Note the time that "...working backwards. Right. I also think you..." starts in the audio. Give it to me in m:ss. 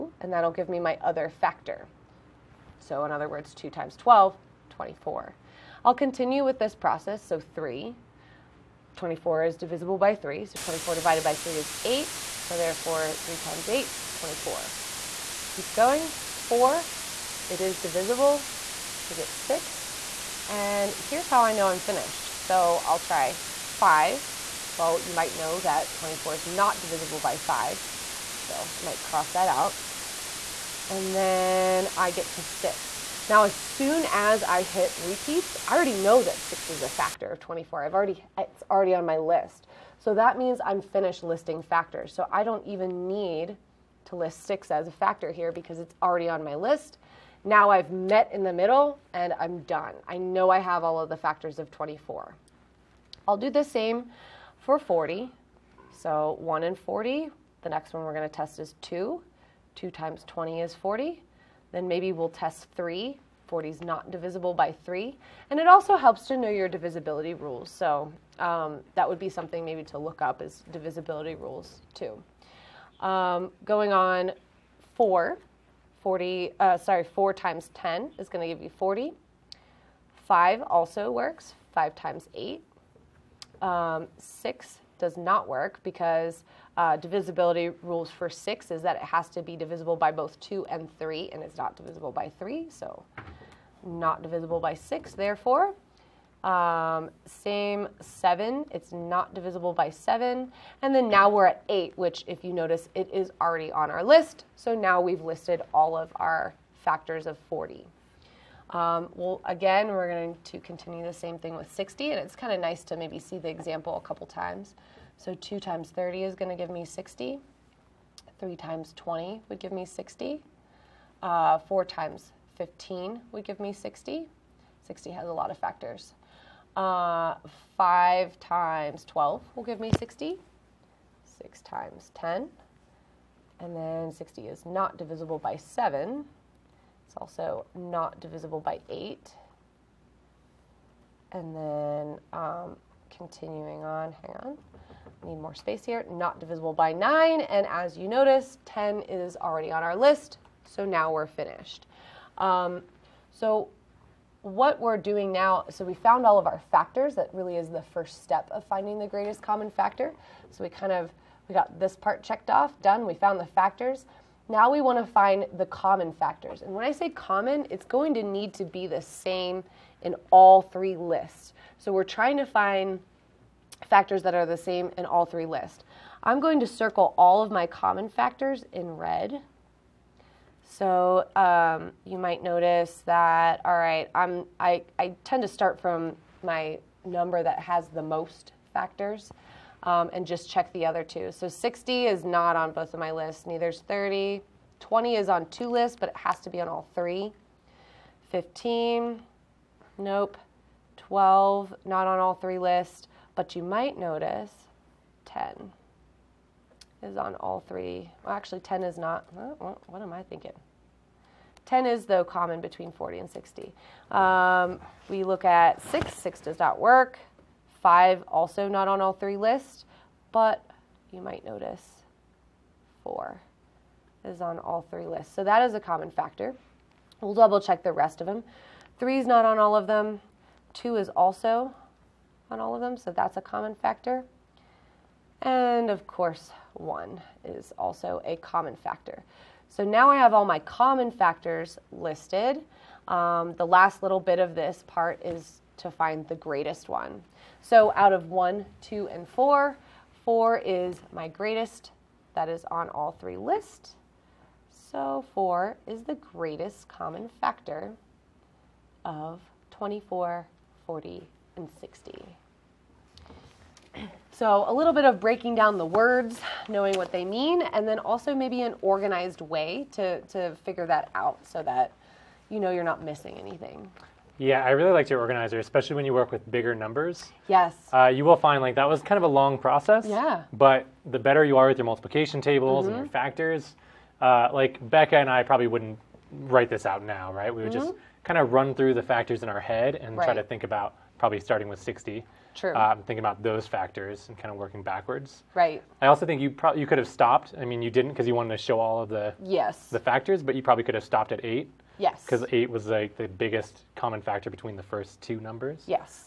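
4:54.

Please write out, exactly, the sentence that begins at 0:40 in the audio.
So that means I'm finished listing factors.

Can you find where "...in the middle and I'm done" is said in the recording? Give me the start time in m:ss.
0:48.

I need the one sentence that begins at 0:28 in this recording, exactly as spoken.
So I might cross that out.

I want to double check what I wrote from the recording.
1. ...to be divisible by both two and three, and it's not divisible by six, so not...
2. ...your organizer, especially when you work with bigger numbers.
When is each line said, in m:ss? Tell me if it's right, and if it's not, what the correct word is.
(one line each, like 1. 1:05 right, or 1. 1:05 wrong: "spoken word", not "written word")
1. 1:29 wrong: "three", not "six"
2. 4:35 right.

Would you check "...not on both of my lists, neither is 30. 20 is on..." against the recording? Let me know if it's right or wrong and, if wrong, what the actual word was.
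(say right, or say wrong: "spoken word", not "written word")
right.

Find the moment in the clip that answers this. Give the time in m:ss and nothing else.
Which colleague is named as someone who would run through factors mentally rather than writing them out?
4:44.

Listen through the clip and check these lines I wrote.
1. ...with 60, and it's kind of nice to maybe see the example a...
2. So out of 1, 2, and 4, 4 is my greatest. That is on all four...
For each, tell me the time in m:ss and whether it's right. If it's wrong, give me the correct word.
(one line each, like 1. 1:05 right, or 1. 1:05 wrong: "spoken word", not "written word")
1. 1:51 right
2. 4:07 wrong: "three", not "four".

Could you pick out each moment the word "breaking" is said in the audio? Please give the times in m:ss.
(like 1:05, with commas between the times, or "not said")
4:25.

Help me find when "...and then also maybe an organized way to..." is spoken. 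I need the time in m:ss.
4:27.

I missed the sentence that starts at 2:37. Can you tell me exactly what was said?
That really is the first step of finding the greatest common factor.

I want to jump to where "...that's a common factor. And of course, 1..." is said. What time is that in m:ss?
3:53.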